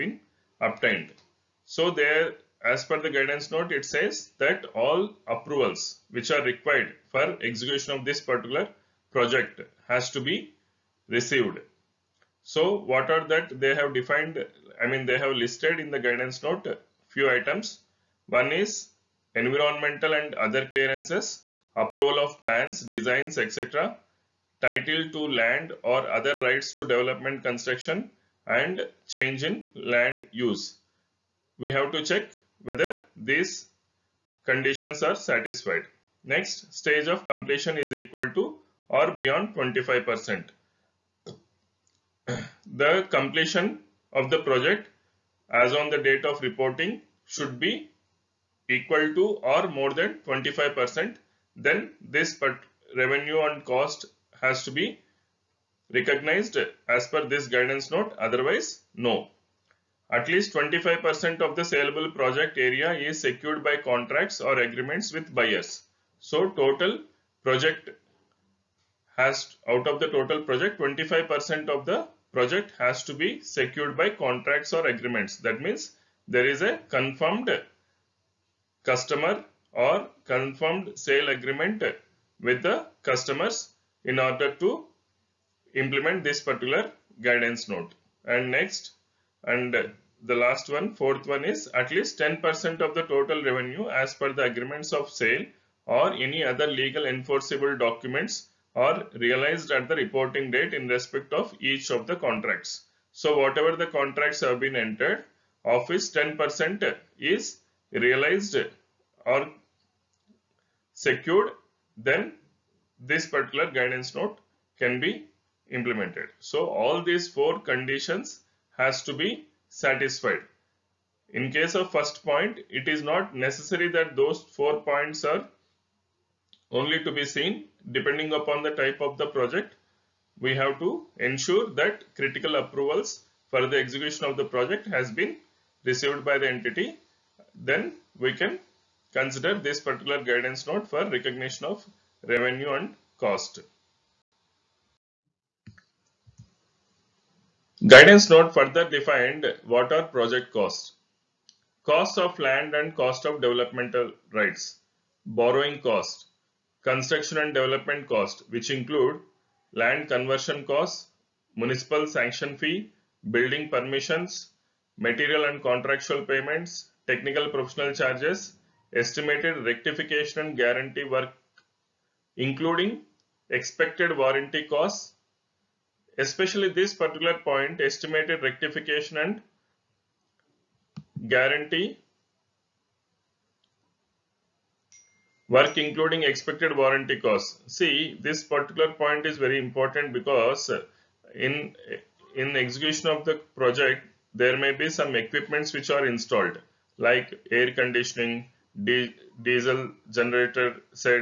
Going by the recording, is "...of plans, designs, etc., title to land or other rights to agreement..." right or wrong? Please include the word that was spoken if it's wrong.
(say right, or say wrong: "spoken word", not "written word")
wrong: "development", not "agreement".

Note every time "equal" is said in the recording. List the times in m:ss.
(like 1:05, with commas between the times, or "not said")
0:37, 0:48.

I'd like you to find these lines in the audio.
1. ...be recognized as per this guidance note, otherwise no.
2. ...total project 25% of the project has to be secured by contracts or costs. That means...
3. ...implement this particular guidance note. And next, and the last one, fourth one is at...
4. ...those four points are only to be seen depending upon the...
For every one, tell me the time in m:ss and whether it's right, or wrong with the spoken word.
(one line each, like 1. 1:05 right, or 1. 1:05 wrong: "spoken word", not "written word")
1. 0:54 right
2. 1:10 wrong: "agreements", not "costs"
3. 1:25 right
4. 2:04 right.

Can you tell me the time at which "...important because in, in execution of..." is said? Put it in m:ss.
3:09.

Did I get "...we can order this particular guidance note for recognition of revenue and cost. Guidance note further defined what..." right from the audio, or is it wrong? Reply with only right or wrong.
wrong.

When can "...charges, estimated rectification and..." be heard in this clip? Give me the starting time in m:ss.
2:47.